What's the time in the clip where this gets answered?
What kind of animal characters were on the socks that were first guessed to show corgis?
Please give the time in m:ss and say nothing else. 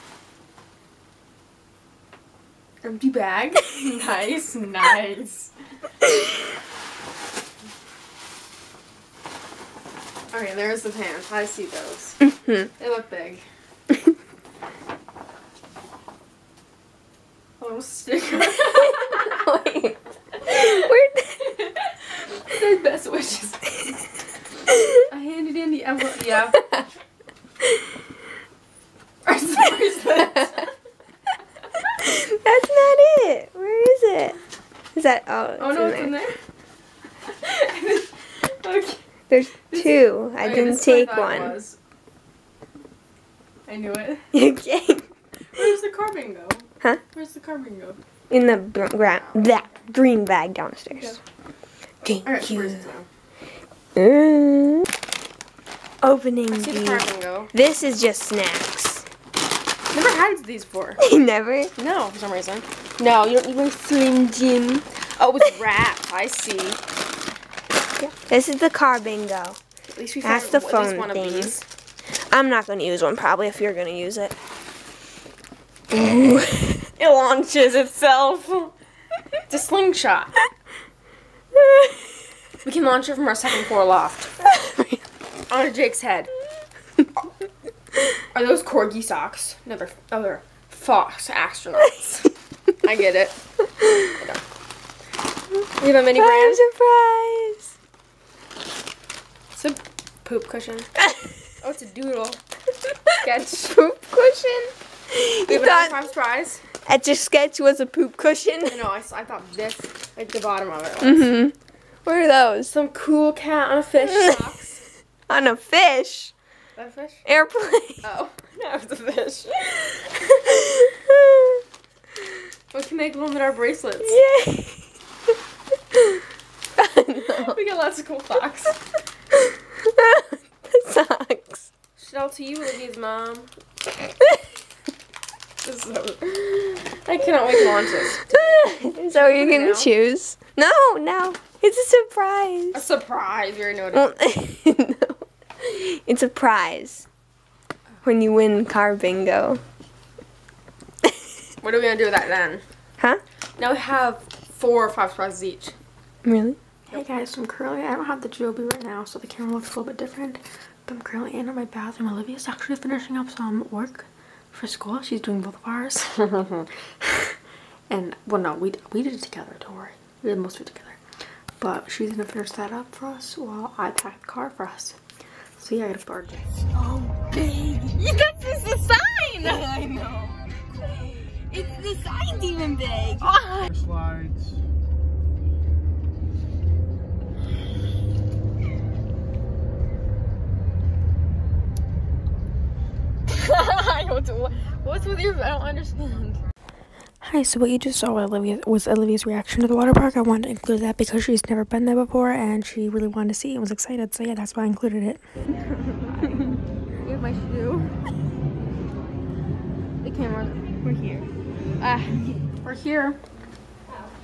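1:30.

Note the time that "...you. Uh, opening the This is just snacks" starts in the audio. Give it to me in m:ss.
0:52.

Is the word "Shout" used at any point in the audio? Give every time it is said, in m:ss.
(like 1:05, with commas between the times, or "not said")
2:11.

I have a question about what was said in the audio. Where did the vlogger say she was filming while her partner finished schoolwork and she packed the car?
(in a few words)
bathroom.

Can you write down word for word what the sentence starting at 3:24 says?
So yeah, that's why I included it.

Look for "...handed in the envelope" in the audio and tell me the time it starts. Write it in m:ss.
0:25.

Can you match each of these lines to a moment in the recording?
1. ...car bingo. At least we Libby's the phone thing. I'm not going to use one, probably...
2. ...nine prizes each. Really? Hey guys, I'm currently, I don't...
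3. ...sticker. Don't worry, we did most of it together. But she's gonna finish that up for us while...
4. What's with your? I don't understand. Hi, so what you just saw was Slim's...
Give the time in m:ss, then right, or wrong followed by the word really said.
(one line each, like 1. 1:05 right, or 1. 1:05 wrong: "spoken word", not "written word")
1. 1:08 wrong: "That", not "Libby"
2. 2:34 wrong: "five", not "nine"
3. 2:49 wrong: "together", not "sticker"
4. 3:14 wrong: "Olivia", not "Slim".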